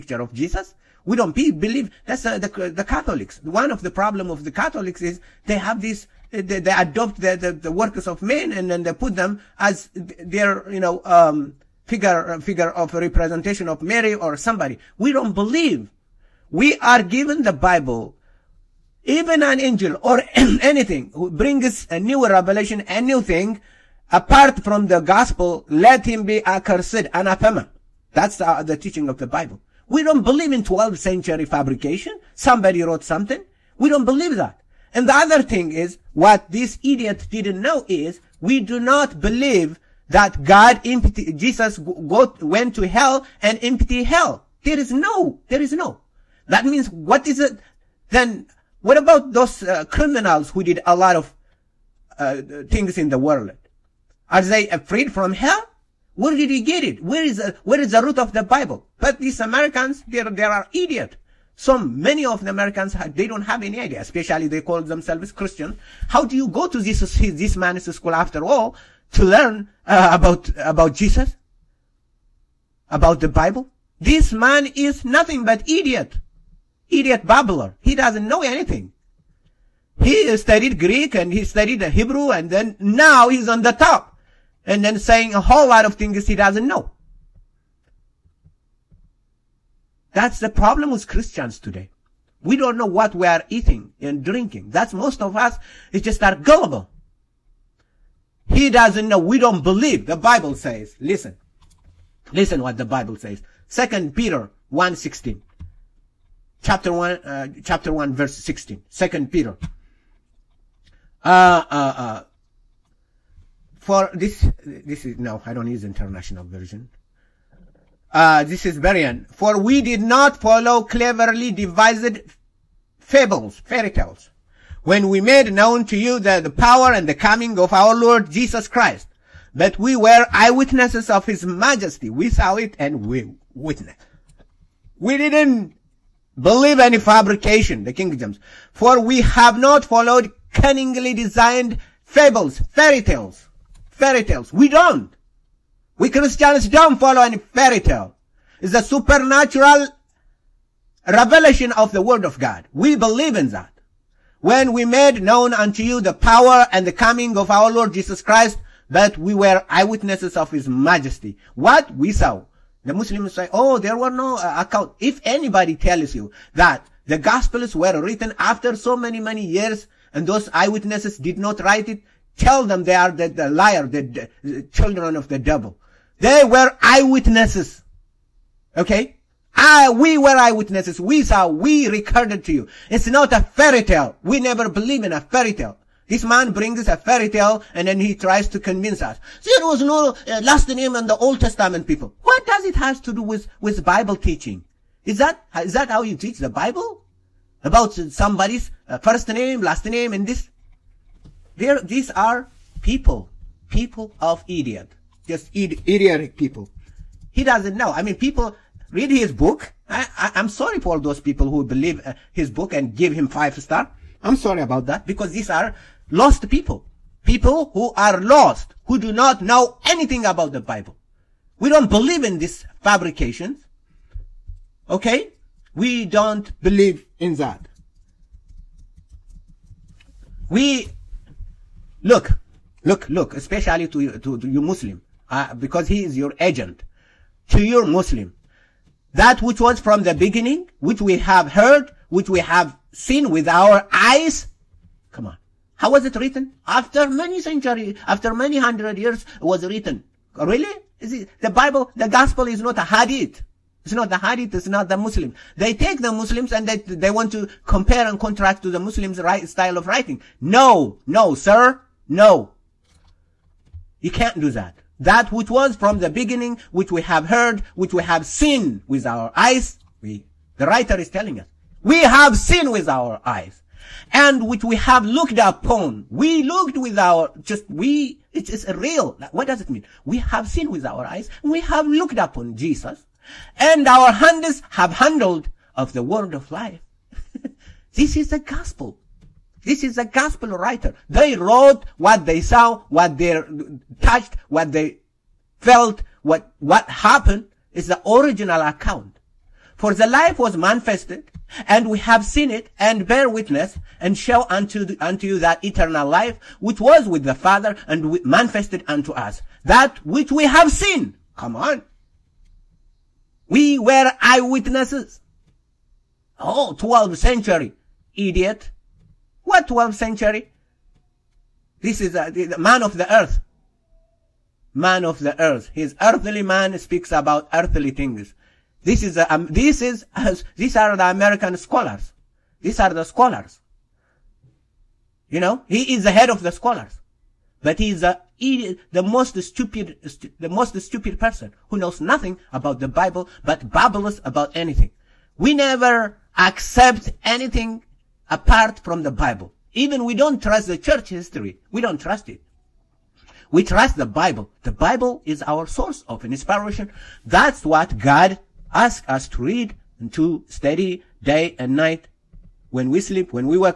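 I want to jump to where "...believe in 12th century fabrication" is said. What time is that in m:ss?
0:30.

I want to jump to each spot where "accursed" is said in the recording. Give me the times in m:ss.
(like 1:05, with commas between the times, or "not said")
0:26.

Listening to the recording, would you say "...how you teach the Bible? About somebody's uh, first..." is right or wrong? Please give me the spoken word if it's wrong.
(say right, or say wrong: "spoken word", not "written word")
right.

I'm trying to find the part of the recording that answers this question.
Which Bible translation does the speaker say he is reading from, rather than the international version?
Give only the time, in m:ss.
1:58.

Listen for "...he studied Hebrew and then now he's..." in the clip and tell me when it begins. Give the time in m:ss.
1:21.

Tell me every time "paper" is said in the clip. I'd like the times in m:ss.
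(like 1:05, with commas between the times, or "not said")
not said.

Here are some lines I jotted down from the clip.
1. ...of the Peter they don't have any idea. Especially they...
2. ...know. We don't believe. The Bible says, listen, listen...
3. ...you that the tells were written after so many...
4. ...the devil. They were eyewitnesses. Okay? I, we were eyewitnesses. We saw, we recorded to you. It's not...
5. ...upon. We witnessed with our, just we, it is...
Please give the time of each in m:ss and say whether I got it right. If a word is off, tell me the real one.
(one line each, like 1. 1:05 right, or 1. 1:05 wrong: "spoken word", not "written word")
1. 1:02 wrong: "Americans", not "Peter"
2. 1:39 right
3. 2:46 wrong: "gospels", not "tells"
4. 2:55 right
5. 4:35 wrong: "looked", not "witnessed".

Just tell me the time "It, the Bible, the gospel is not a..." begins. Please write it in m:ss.
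4:11.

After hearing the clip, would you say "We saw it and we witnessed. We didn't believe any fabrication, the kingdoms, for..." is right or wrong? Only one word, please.
right.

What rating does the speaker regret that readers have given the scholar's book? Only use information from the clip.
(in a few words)
5 stars.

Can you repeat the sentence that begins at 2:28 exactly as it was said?
It's a supernatural revelation of the word of God.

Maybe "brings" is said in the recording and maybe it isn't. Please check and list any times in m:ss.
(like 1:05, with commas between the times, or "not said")
0:21, 3:06.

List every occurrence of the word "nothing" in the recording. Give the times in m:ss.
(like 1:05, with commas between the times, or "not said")
1:15, 5:42.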